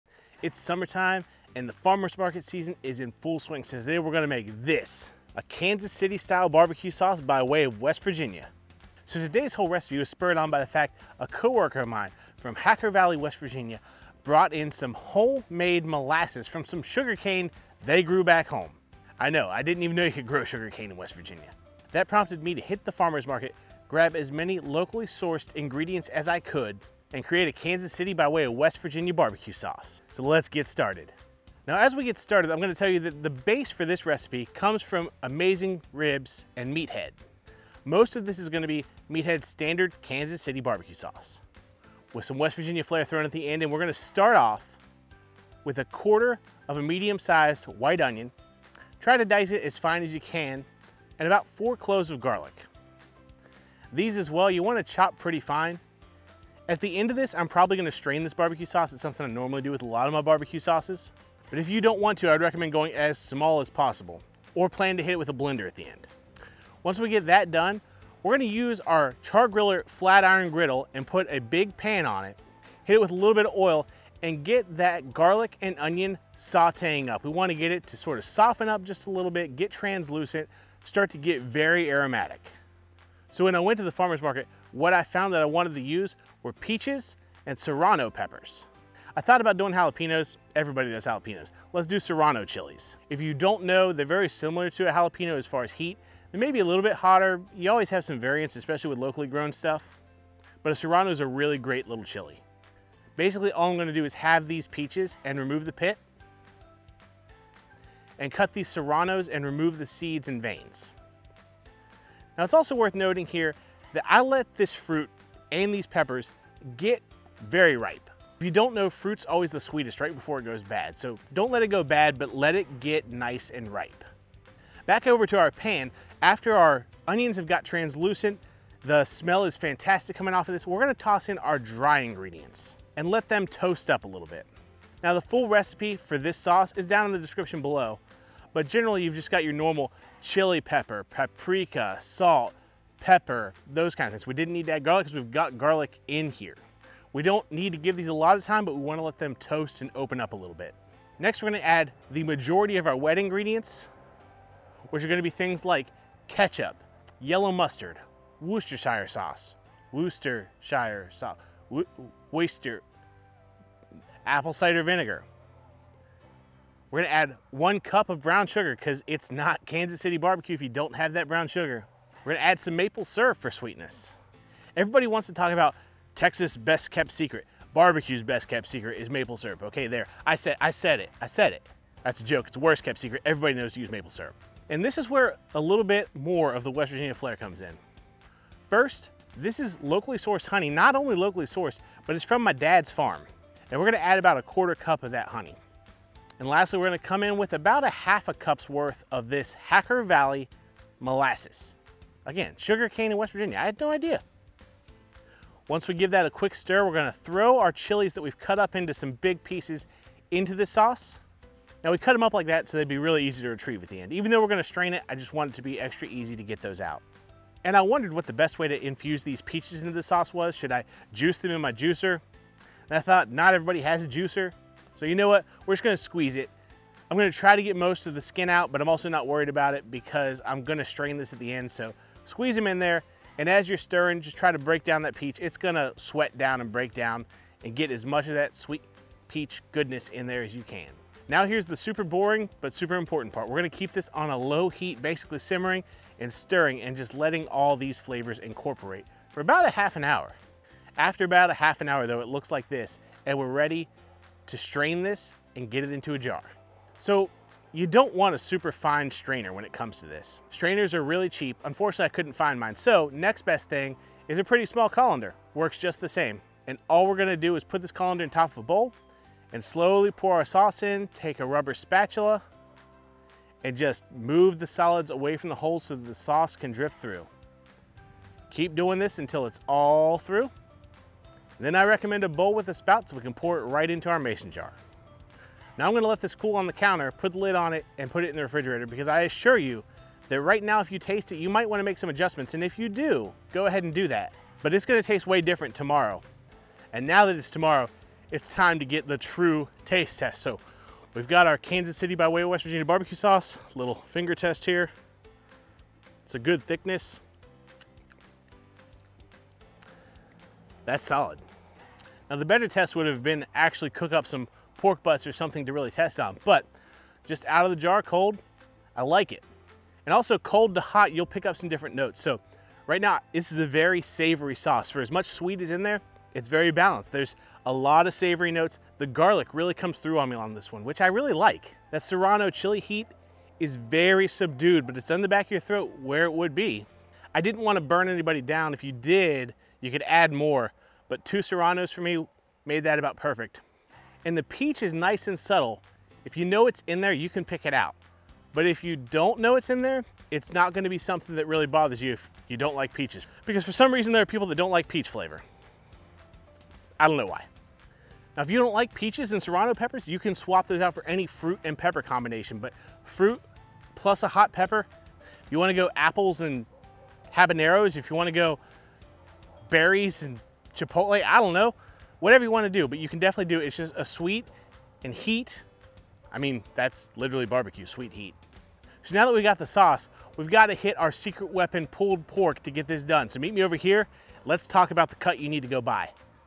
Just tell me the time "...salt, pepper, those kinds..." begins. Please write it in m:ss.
2:22.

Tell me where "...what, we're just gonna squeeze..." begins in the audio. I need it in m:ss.
3:45.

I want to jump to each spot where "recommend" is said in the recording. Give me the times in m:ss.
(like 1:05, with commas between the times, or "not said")
1:02, 4:41.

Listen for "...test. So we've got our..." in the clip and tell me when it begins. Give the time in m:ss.
5:00.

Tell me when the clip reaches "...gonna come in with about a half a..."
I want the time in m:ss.
3:16.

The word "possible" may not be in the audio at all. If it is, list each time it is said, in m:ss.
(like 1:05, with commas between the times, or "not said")
1:03.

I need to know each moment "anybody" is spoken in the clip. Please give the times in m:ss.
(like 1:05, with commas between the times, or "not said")
5:38.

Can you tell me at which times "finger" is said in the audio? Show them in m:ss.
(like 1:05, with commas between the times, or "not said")
5:03.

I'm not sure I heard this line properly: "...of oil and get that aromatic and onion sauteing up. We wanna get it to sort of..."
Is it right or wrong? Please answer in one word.
wrong.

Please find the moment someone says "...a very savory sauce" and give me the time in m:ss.
5:23.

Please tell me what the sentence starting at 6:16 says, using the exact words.
I mean, that's literally barbecue, sweet heat.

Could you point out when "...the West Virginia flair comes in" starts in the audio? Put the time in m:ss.
3:06.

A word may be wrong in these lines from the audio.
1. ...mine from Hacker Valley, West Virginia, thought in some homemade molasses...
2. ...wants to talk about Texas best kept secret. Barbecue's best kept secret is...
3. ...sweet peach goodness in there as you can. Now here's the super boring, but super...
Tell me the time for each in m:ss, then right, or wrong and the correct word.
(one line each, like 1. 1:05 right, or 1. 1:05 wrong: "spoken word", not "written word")
1. 0:11 wrong: "brought", not "thought"
2. 2:55 right
3. 3:58 right.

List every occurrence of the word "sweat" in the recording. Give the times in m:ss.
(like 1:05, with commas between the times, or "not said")
3:55.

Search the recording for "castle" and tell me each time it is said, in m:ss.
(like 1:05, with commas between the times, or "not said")
not said.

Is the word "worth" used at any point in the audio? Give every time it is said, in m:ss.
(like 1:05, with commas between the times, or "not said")
1:52, 3:18.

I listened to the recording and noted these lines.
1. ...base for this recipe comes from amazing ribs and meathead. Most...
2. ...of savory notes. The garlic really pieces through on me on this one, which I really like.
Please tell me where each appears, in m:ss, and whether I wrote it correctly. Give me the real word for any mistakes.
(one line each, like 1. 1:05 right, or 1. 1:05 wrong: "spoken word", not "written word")
1. 0:33 right
2. 5:28 wrong: "comes", not "pieces".